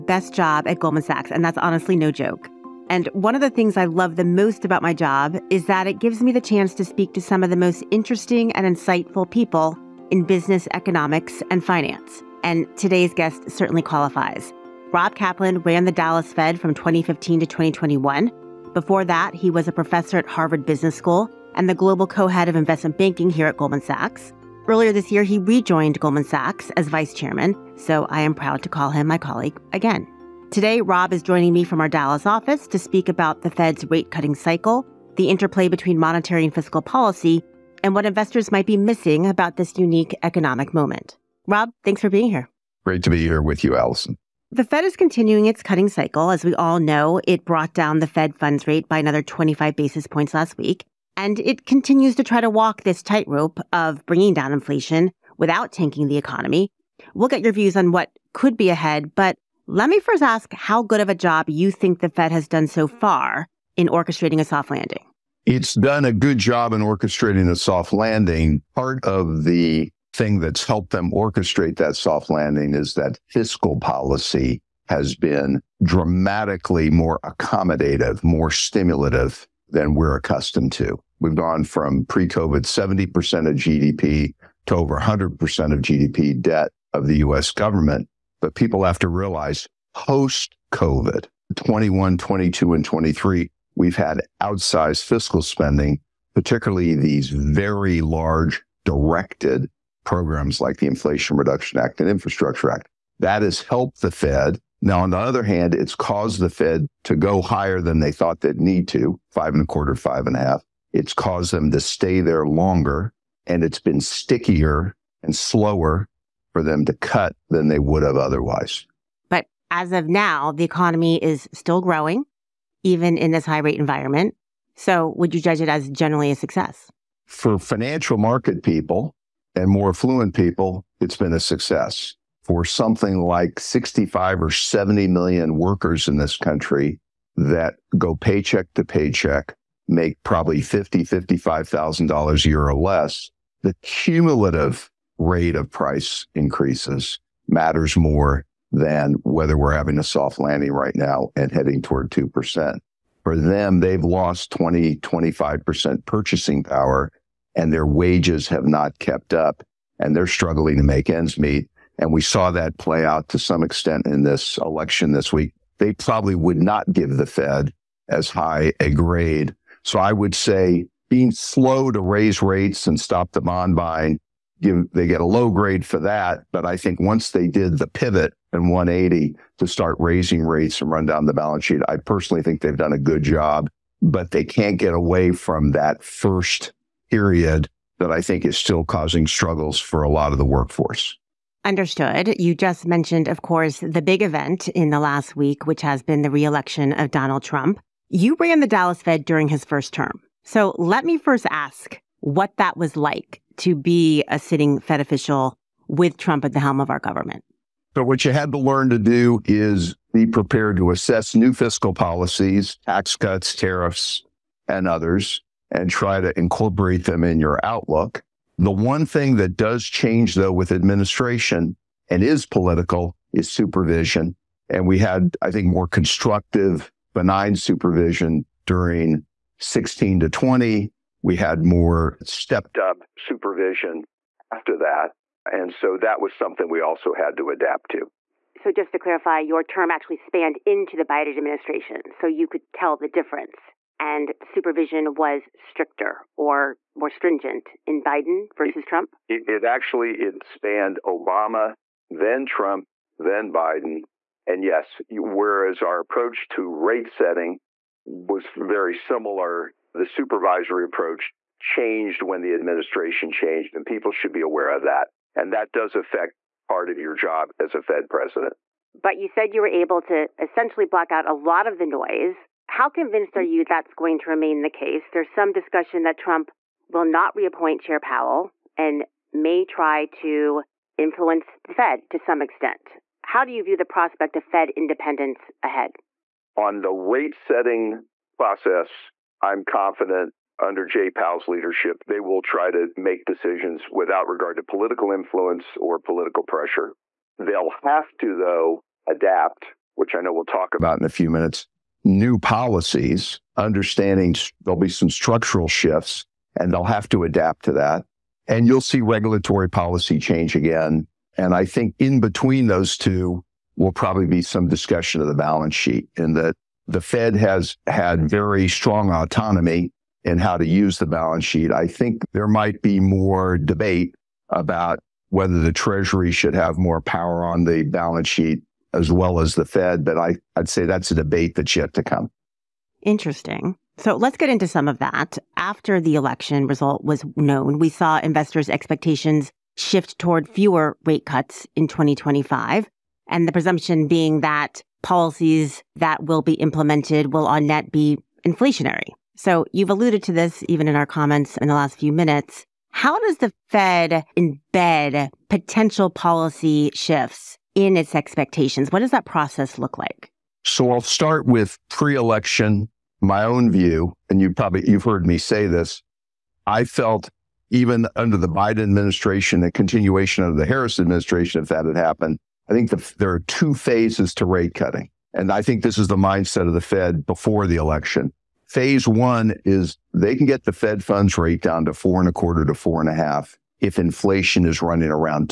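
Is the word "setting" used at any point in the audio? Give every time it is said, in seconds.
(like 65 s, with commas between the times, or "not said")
257 s, 287 s.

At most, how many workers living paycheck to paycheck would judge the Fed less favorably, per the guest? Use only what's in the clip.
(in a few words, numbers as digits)
70 million.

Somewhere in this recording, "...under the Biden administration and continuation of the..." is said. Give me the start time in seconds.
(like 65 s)
368 s.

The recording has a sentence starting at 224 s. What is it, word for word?
And we had, I think, more constructive, benign supervision during 16 to 20.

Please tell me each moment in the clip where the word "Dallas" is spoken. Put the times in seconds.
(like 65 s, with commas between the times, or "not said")
15 s, 31 s, 198 s.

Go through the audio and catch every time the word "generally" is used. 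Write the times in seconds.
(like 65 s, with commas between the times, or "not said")
125 s.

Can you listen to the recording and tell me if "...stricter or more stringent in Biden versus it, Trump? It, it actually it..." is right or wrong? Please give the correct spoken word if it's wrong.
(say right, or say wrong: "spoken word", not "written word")
right.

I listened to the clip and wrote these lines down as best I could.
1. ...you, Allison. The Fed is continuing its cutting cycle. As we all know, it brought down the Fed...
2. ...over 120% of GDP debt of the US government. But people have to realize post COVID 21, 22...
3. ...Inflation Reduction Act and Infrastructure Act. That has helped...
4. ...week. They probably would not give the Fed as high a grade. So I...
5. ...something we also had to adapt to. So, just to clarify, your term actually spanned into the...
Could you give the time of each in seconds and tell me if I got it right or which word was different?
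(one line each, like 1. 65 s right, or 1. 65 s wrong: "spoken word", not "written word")
1. 43 s right
2. 84 s wrong: "100", not "120"
3. 100 s right
4. 165 s right
5. 236 s right.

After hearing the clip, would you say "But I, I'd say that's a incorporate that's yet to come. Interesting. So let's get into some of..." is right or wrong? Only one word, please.
wrong.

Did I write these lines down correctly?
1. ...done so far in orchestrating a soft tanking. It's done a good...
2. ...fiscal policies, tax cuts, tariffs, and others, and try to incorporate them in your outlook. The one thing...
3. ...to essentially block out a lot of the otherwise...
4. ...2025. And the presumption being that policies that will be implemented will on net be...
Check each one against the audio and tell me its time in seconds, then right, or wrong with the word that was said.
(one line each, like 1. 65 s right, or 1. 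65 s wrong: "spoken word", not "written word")
1. 62 s wrong: "landing", not "tanking"
2. 211 s right
3. 270 s wrong: "noise", not "otherwise"
4. 341 s right.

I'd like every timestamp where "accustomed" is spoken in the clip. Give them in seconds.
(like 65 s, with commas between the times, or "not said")
80 s.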